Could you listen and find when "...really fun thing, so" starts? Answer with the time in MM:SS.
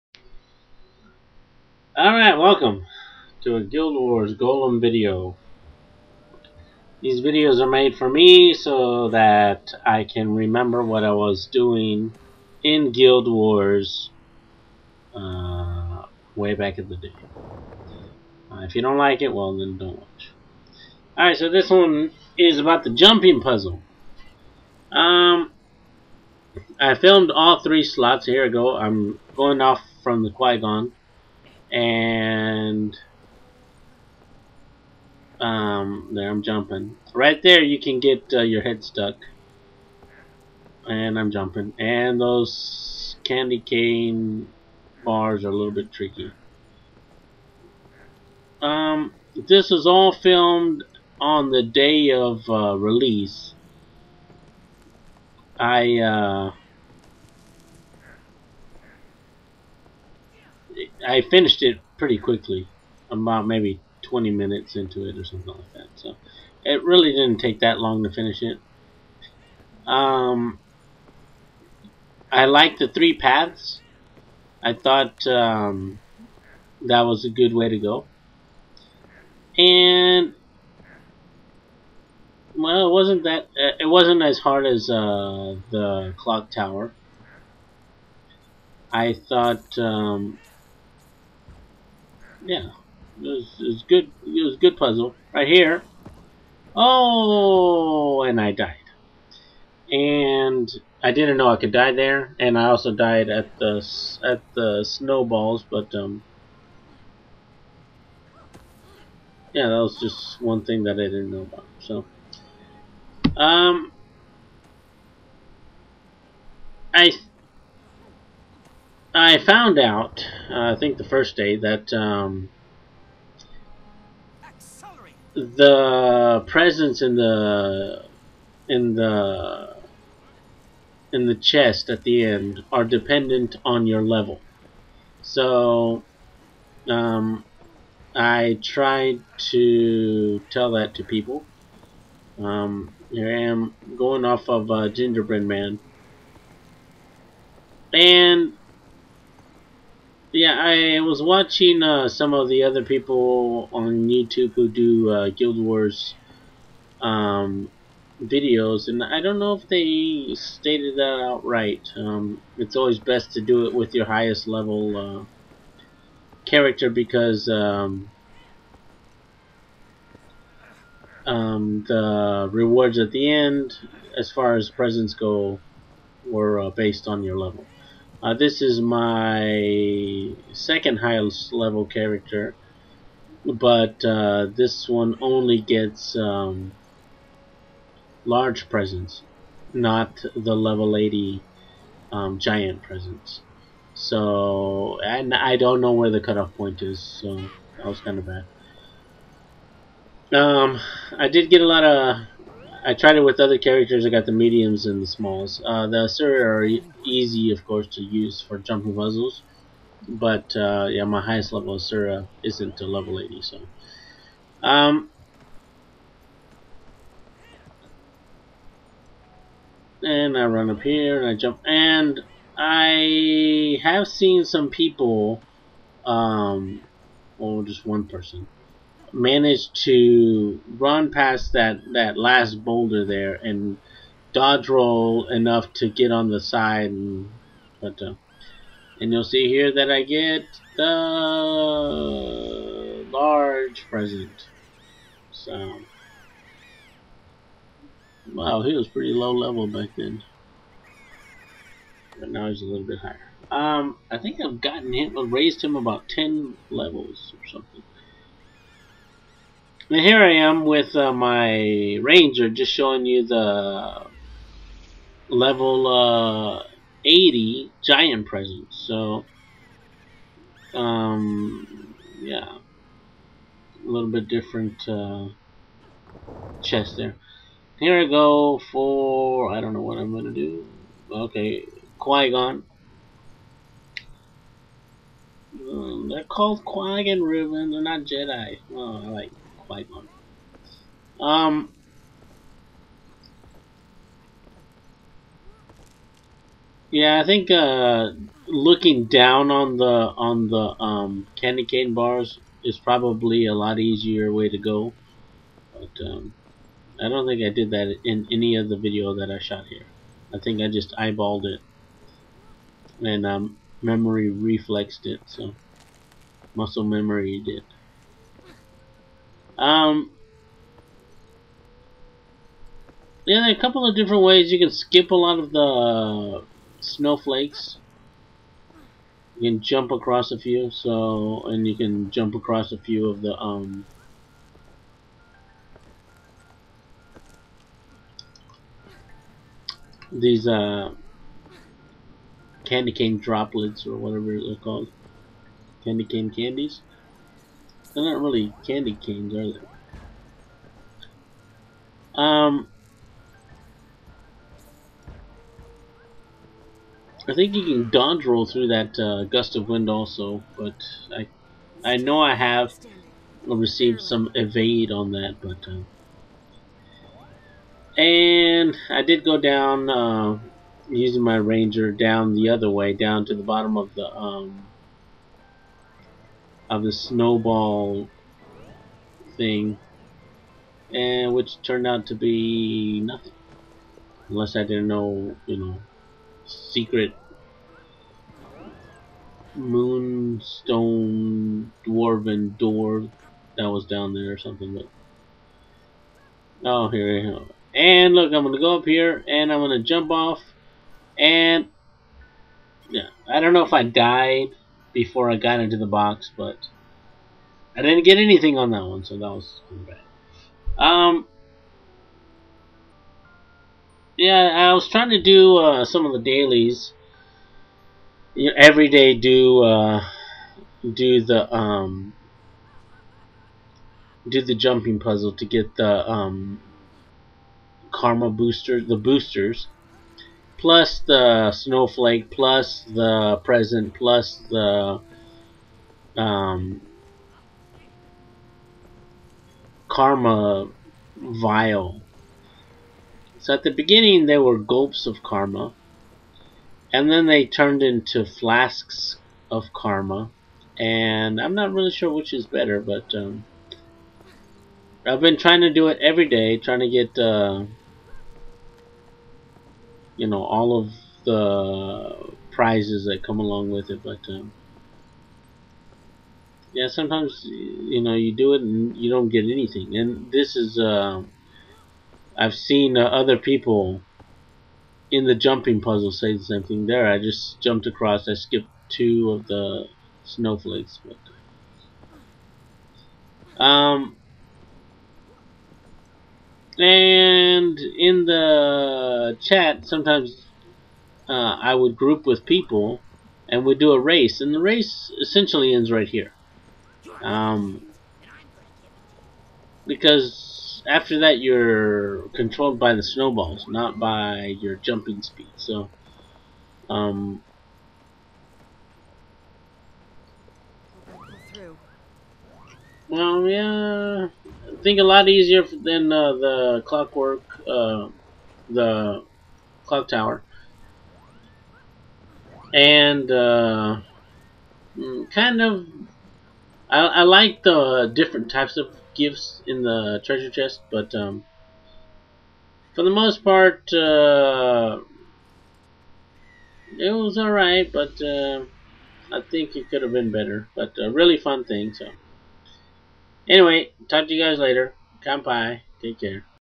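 09:01.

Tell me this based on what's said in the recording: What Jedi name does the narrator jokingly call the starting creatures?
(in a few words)
Qui-Gon.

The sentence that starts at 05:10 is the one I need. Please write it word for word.
I think I just eyeballed it and um, memory reflexed it.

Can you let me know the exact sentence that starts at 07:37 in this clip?
Uh, you know all of the prizes that come along with it.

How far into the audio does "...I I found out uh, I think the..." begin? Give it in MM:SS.
01:56.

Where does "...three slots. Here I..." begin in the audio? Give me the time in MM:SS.
00:27.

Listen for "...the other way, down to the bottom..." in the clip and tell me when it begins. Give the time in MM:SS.
06:12.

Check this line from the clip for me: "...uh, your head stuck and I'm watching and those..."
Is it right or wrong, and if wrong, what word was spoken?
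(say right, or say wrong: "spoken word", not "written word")
wrong: "jumping", not "watching".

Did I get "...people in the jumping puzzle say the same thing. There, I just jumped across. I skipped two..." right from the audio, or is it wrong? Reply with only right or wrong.
right.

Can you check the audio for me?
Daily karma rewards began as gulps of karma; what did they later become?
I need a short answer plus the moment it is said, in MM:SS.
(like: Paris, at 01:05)
Flasks of karma, at 07:28.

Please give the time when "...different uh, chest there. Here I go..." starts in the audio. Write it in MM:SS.
04:34.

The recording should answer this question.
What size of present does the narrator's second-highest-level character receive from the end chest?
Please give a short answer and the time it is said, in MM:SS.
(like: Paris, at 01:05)
Large presents, at 03:08.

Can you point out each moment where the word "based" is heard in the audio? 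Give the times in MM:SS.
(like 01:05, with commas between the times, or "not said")
02:56.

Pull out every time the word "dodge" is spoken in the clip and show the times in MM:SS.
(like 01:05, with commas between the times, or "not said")
03:54, 05:57.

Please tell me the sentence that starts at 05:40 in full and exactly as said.
These uh, candy cane droplets or whatever they're called, candy cane candies.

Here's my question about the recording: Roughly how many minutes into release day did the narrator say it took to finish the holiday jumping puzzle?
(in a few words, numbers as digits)
20.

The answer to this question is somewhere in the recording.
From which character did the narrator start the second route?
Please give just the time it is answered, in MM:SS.
02:24.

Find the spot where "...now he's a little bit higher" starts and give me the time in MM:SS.
04:12.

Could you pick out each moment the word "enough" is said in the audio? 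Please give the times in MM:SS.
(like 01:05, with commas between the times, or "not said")
03:55.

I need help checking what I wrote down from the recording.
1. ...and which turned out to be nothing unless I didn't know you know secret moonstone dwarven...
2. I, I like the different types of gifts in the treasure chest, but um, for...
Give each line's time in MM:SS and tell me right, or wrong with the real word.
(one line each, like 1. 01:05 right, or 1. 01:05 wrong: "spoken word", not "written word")
1. 06:20 right
2. 08:46 right.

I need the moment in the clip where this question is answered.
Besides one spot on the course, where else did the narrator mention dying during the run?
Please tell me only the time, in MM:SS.
01:44.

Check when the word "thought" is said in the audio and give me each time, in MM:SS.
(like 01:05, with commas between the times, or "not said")
01:14, 01:29.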